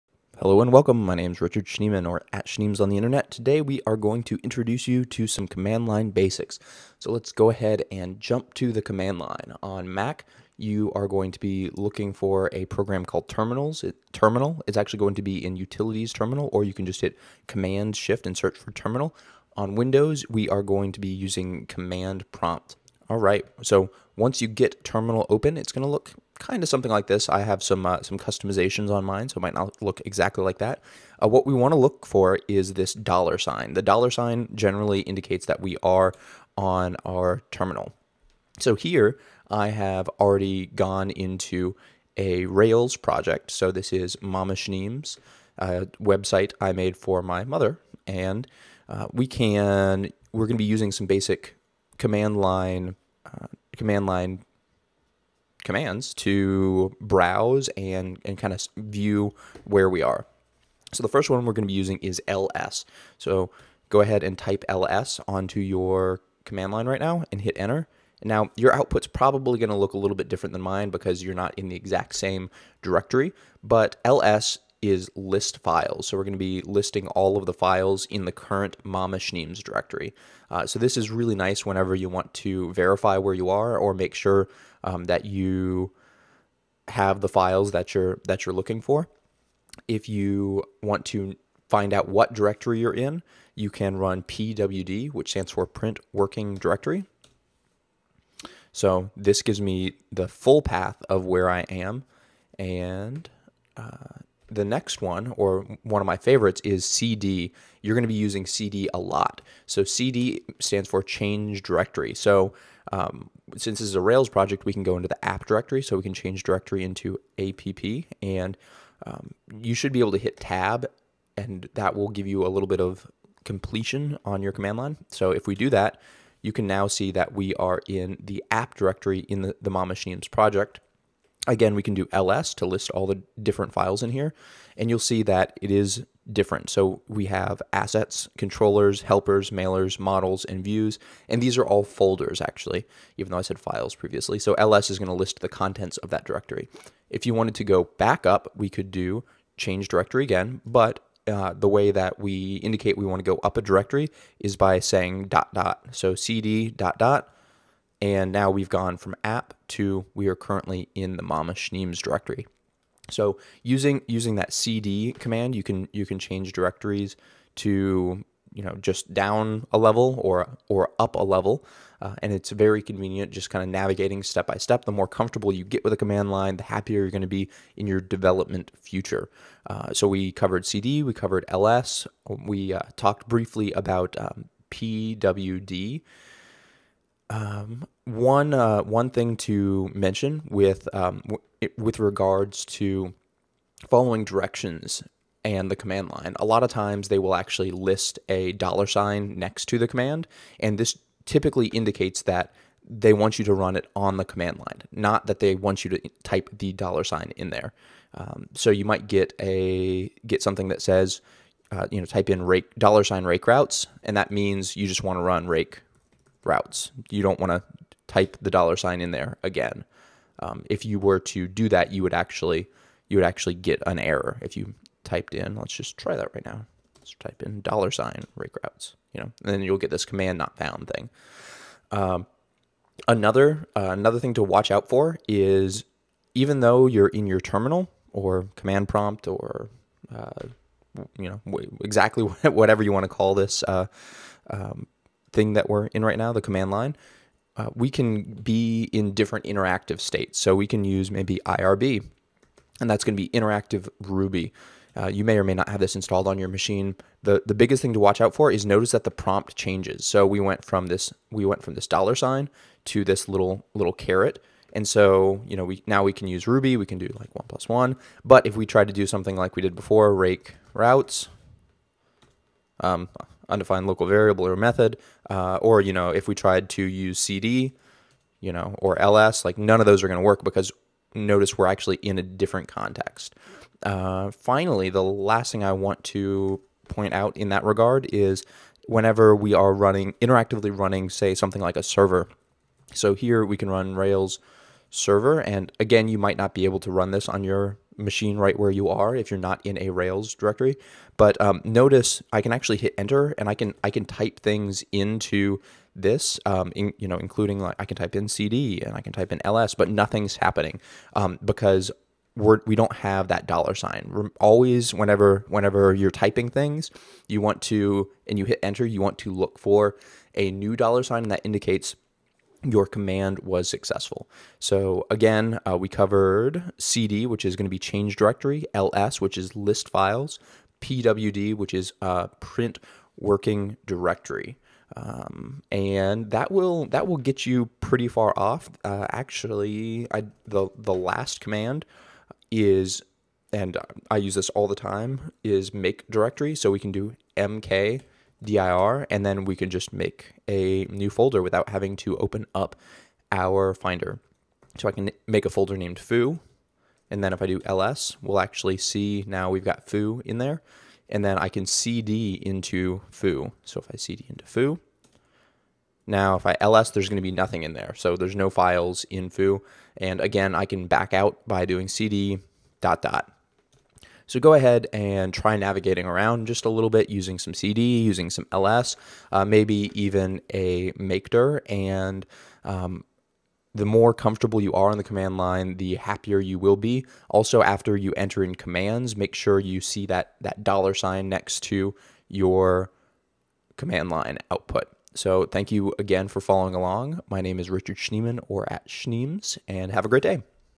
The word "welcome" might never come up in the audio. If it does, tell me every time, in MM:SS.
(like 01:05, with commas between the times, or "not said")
00:00.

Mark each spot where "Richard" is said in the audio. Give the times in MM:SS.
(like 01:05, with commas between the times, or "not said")
00:01, 06:37.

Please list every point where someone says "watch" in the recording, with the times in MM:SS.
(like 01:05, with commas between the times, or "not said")
03:54, 04:17.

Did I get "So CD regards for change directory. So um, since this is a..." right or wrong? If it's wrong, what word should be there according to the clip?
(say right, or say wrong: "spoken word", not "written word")
wrong: "stands", not "regards".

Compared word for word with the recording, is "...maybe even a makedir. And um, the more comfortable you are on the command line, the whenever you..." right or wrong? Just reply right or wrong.
wrong.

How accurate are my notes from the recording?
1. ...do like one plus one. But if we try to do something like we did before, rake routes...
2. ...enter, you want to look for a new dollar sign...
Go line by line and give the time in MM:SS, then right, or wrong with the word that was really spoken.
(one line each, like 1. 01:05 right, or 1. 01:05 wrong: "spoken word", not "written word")
1. 04:26 right
2. 05:18 right.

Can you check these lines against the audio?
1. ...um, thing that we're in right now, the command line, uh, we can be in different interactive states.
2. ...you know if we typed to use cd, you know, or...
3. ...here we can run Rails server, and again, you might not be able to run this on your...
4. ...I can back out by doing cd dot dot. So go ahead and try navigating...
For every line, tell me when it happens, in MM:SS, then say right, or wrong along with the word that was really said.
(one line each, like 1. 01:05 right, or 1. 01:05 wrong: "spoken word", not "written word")
1. 04:04 right
2. 04:35 wrong: "tried", not "typed"
3. 04:53 right
4. 06:10 right.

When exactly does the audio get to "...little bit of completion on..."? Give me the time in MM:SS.
02:02.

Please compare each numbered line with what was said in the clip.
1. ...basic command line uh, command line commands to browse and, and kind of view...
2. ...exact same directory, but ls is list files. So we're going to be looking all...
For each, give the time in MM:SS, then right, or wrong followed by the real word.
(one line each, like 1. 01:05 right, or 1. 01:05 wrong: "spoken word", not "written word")
1. 00:51 right
2. 01:11 wrong: "listing", not "looking".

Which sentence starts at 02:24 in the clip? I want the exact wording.
So ls is going to list the contents of that directory.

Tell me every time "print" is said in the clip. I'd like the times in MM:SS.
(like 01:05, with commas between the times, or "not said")
01:35, 05:32.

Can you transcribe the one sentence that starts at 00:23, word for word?
All right, so once you get Terminal open, it's going to look kind of something like this.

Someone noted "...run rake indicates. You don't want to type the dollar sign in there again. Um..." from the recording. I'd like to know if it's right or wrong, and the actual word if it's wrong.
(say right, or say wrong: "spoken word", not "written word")
wrong: "routes", not "indicates".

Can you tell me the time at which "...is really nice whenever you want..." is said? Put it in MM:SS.
01:20.